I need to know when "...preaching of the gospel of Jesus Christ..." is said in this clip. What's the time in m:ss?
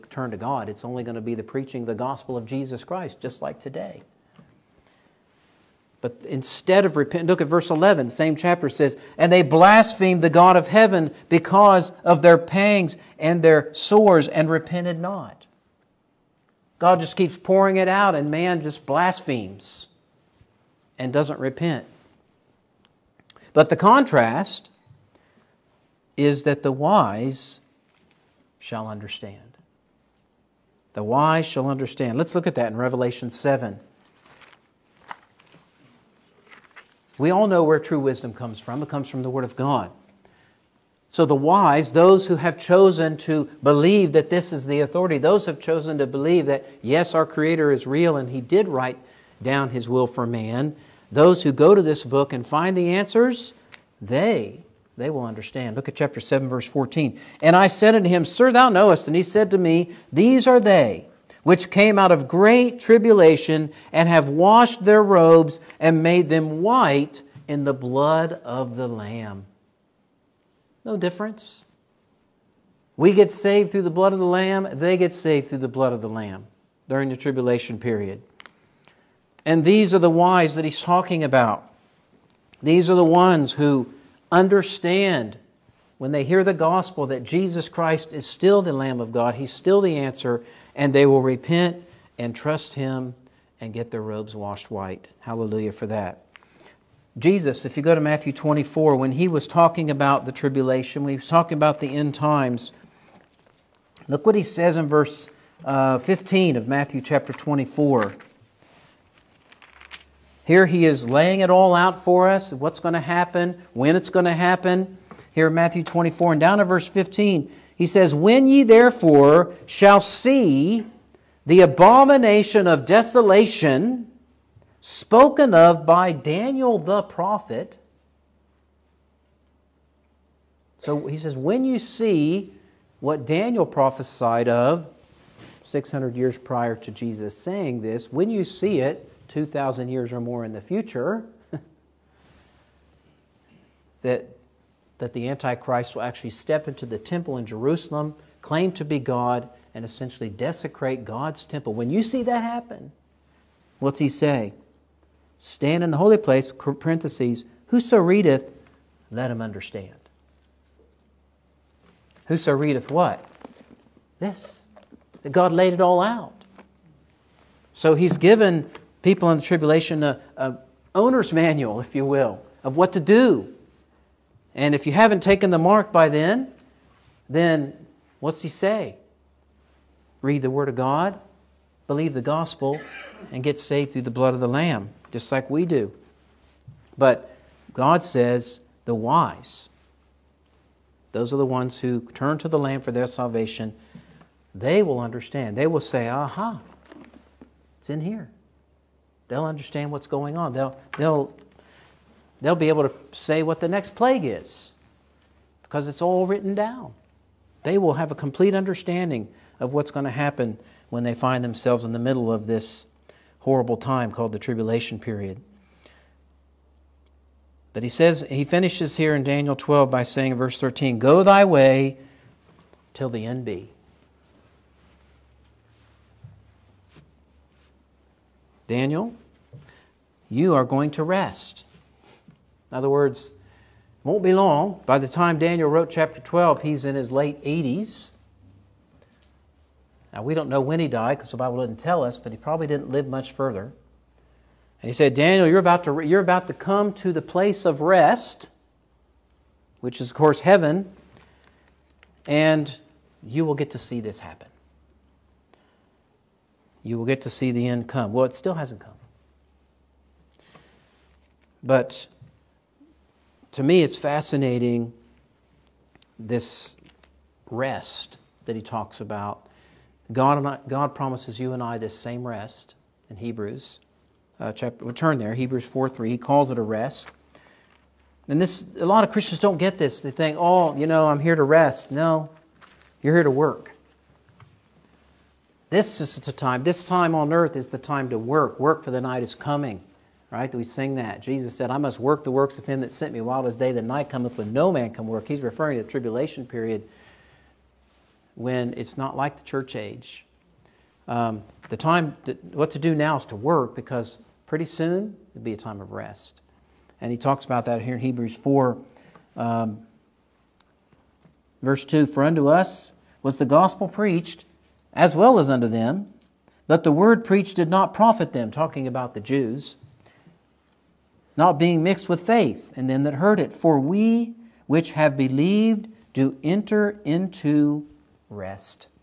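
0:01.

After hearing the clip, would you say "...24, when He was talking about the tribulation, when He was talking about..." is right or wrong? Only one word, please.
right.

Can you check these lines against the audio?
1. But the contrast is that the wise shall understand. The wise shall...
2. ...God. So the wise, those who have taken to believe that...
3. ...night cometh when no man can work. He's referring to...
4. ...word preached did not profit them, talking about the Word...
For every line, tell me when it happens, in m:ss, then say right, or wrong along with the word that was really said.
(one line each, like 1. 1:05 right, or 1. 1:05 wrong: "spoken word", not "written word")
1. 0:23 right
2. 0:39 wrong: "chosen", not "taken"
3. 4:53 right
4. 5:16 wrong: "Jews", not "Word".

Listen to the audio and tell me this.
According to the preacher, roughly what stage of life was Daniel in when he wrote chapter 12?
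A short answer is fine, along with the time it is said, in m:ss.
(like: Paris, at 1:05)
late 80s, at 3:57.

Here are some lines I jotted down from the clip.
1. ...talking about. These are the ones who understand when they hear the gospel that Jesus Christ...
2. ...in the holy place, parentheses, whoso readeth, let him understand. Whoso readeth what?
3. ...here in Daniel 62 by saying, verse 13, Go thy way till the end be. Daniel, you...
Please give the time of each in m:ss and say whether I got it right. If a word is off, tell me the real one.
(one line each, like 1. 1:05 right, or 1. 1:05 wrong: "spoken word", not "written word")
1. 1:20 right
2. 2:35 right
3. 3:38 wrong: "12", not "62".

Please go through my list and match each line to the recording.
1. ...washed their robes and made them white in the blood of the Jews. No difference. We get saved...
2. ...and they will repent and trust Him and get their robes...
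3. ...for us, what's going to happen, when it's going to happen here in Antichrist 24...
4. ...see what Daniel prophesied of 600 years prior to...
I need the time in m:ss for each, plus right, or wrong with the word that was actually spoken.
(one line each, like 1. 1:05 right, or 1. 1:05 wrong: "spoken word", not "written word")
1. 1:04 wrong: "Lamb", not "Jews"
2. 1:30 right
3. 1:52 wrong: "Matthew", not "Antichrist"
4. 2:11 right.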